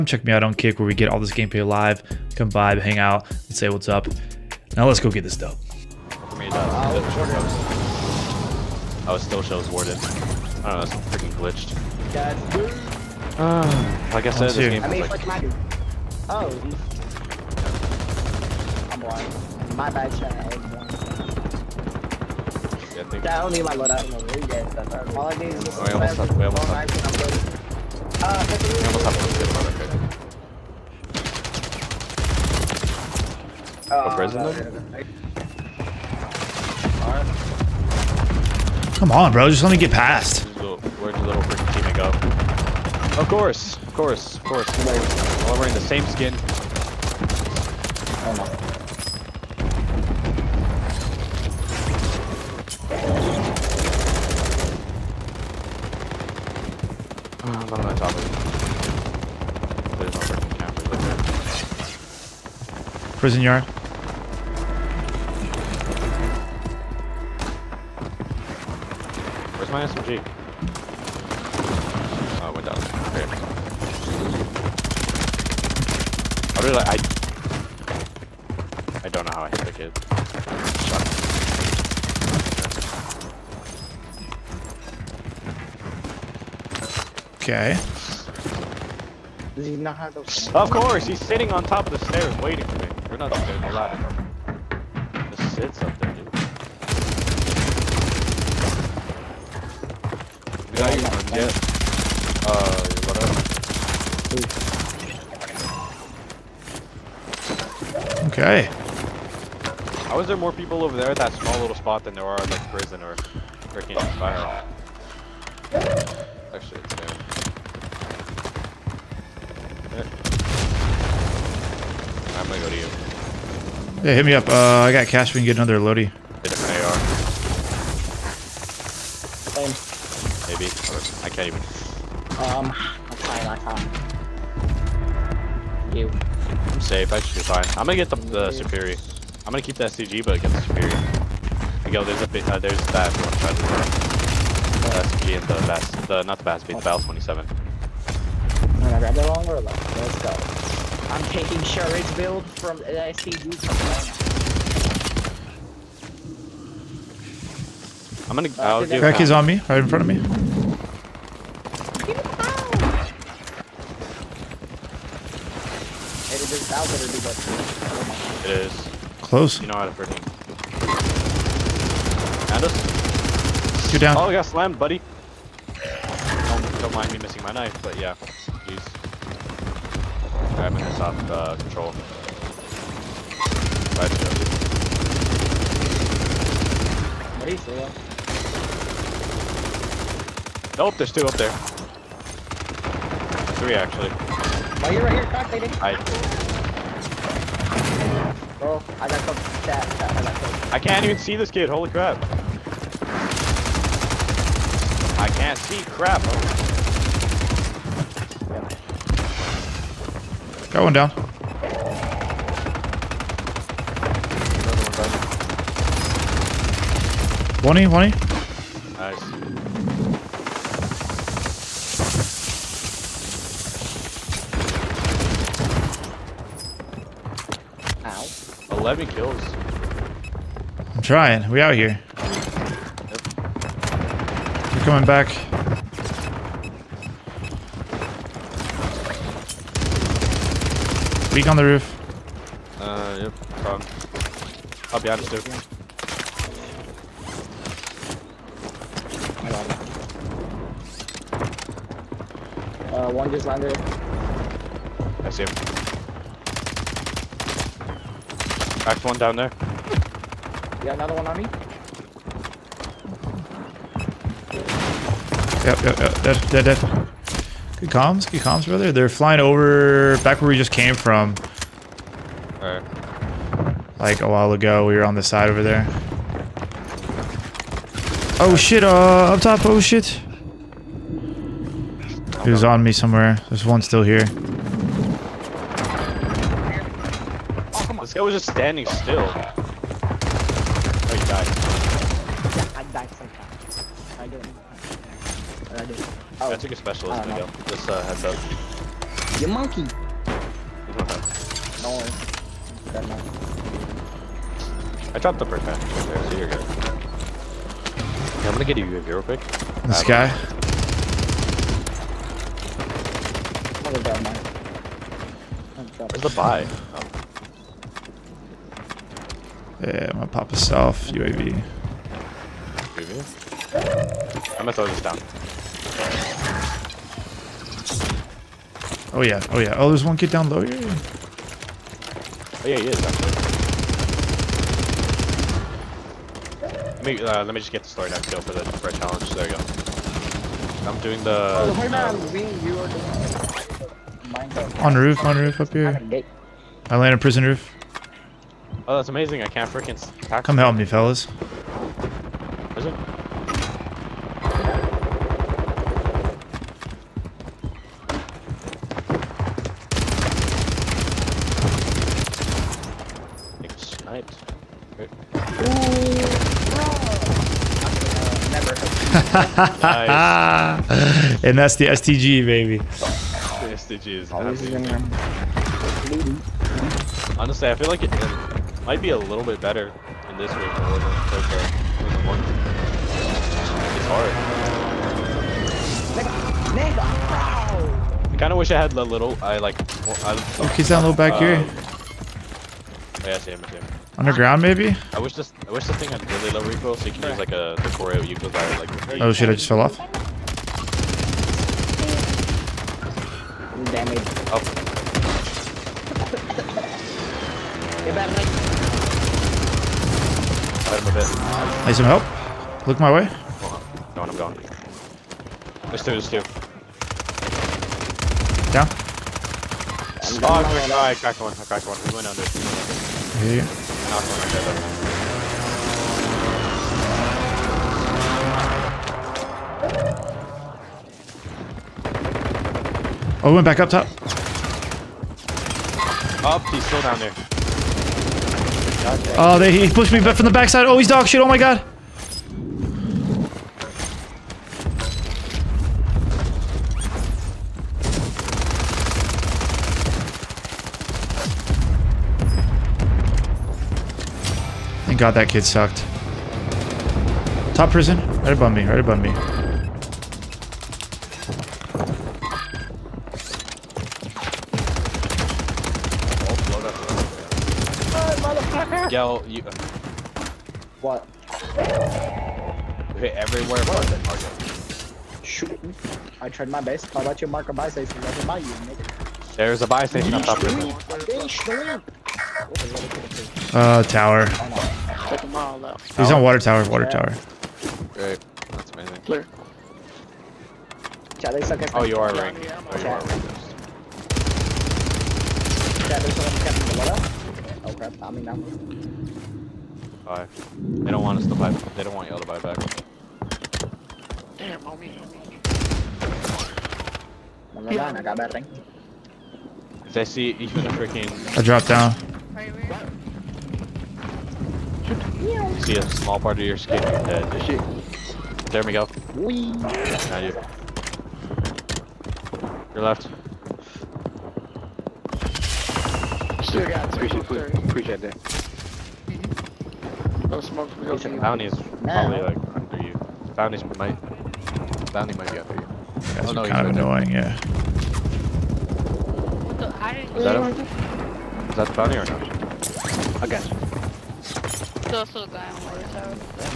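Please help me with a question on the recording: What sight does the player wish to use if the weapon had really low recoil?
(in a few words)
Coreo.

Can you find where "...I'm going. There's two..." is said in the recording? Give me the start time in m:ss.
6:54.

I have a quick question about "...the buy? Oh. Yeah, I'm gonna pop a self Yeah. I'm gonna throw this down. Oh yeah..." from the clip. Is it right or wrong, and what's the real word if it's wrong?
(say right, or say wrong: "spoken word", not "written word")
wrong: "UAV", not "Yeah".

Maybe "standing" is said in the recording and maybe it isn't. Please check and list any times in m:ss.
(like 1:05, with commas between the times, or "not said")
4:48.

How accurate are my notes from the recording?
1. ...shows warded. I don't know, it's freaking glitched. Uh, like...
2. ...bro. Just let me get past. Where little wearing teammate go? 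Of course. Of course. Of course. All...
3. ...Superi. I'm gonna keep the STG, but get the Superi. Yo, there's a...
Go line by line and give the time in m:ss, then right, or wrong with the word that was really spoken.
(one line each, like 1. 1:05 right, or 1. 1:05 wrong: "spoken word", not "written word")
1. 0:09 right
2. 0:39 wrong: "freaking", not "wearing"
3. 2:18 right.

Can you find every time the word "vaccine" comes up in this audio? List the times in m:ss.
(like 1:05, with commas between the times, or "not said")
not said.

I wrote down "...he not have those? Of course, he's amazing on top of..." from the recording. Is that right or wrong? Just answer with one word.
wrong.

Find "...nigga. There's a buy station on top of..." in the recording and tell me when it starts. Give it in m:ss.
7:58.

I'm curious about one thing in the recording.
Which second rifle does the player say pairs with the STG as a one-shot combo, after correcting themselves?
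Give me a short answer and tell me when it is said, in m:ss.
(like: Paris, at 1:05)
Battle 27, at 2:26.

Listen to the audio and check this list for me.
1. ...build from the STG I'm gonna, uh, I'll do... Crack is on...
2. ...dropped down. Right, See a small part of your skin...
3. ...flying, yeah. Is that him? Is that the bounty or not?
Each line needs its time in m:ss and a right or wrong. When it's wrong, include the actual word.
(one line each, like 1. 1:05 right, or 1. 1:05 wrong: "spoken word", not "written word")
1. 2:32 right
2. 8:31 right
3. 8:56 wrong: "annoying", not "flying".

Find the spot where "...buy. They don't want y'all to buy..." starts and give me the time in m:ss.
8:21.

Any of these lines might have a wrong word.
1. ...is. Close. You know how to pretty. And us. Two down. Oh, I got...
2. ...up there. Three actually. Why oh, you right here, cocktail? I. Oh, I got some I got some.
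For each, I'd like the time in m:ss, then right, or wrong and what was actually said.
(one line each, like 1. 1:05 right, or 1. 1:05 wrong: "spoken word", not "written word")
1. 2:48 right
2. 3:11 right.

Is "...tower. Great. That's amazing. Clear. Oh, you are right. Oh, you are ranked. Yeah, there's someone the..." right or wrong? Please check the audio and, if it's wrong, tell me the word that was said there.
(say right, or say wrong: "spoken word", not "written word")
right.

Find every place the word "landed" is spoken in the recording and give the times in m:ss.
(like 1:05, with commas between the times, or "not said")
4:13, 5:46.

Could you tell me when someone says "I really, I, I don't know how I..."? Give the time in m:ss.
1:16.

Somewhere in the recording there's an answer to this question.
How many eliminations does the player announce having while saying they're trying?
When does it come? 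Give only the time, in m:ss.
3:48.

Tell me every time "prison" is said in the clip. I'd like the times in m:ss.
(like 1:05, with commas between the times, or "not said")
0:34, 1:03, 1:52, 5:47, 7:37.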